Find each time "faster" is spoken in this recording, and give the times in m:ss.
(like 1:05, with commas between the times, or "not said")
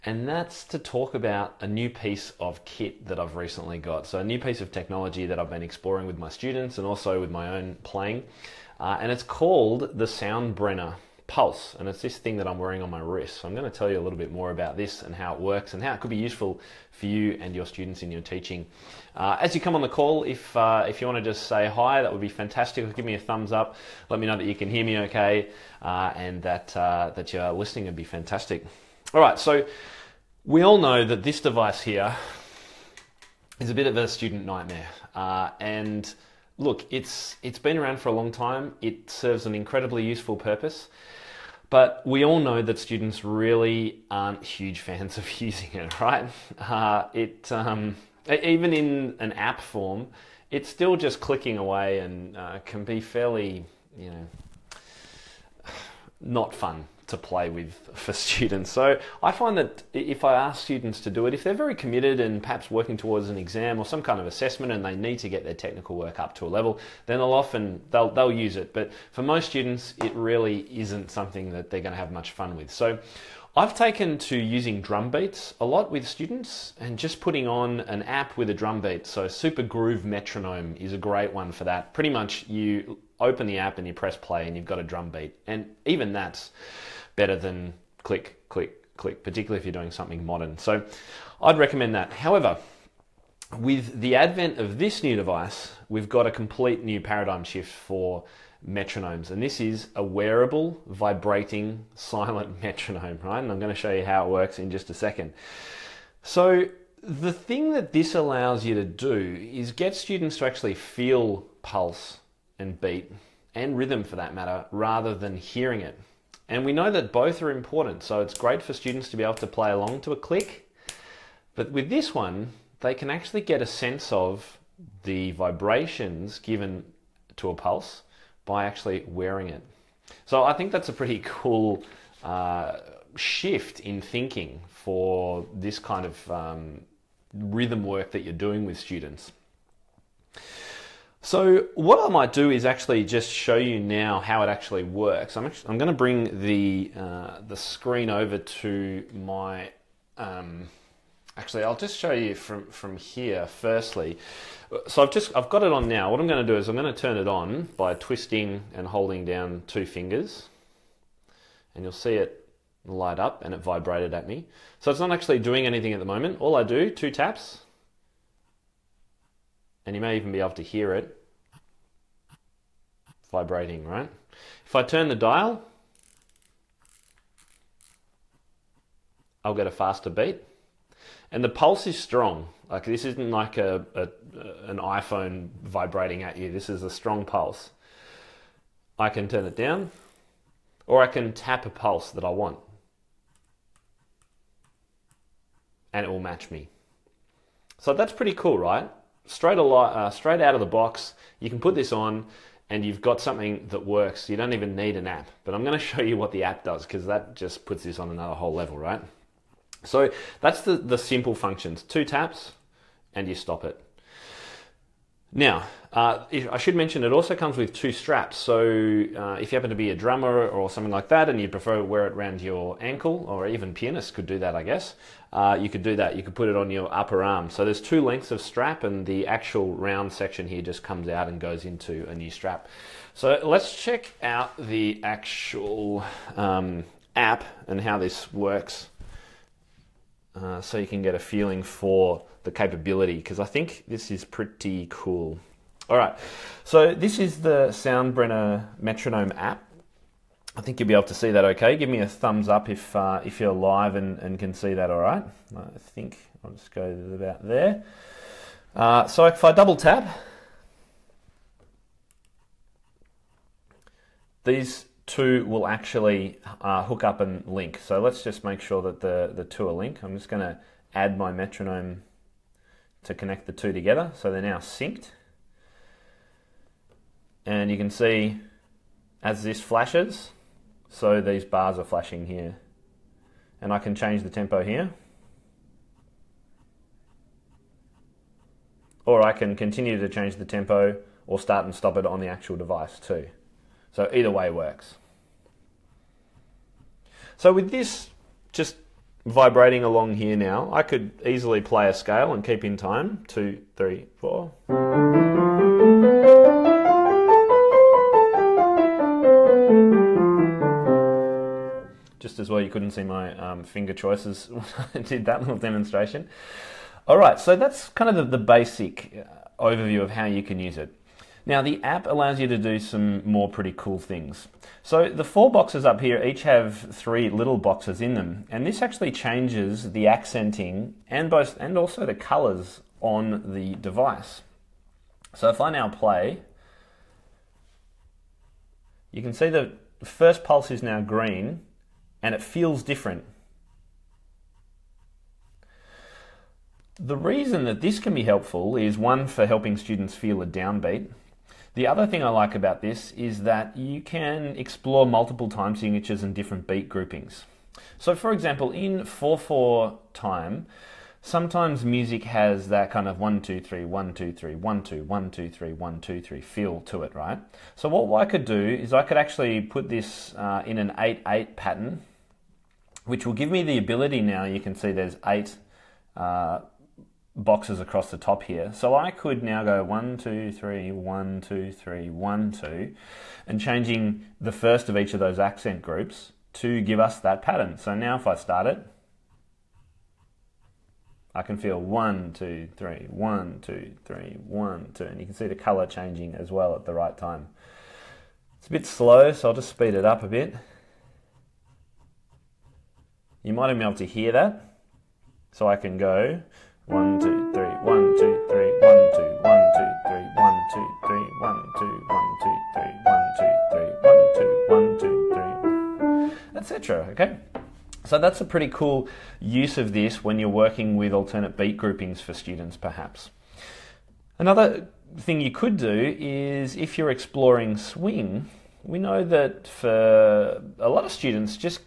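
2:59.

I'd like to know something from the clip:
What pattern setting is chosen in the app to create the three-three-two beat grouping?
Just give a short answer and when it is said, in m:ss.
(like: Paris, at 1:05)
8 8, at 6:10.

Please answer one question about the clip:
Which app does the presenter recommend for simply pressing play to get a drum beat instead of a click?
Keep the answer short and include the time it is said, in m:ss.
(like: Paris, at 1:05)
Super Groove Metronome, at 1:19.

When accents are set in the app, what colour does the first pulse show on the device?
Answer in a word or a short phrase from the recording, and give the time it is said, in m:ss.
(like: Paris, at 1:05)
green, at 5:41.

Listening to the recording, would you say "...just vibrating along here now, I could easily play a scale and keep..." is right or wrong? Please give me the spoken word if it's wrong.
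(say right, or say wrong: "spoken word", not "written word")
right.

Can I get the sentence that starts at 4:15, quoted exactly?
I think I'll just go about there.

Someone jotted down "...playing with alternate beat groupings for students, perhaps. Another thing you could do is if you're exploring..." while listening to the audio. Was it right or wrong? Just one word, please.
wrong.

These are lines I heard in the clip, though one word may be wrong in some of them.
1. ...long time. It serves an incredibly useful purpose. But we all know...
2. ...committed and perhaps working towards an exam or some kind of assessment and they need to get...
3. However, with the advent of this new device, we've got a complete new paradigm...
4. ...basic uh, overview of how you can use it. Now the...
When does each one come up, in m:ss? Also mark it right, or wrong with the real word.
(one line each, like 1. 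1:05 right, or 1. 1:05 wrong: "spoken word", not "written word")
1. 0:38 right
2. 1:01 right
3. 1:32 right
4. 5:18 right.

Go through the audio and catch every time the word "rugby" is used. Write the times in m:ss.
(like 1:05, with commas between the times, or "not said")
not said.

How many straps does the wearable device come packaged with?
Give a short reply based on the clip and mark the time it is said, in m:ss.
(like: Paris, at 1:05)
2, at 3:37.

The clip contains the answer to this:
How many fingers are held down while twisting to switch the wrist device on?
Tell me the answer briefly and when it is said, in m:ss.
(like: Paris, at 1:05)
2, at 2:39.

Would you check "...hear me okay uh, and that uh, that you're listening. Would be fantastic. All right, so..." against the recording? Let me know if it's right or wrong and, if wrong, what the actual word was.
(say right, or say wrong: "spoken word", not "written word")
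right.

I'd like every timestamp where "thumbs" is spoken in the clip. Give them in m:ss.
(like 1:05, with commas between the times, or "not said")
0:23, 4:12.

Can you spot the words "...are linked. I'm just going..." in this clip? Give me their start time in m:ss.
4:29.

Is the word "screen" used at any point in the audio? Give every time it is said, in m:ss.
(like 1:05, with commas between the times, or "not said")
2:27.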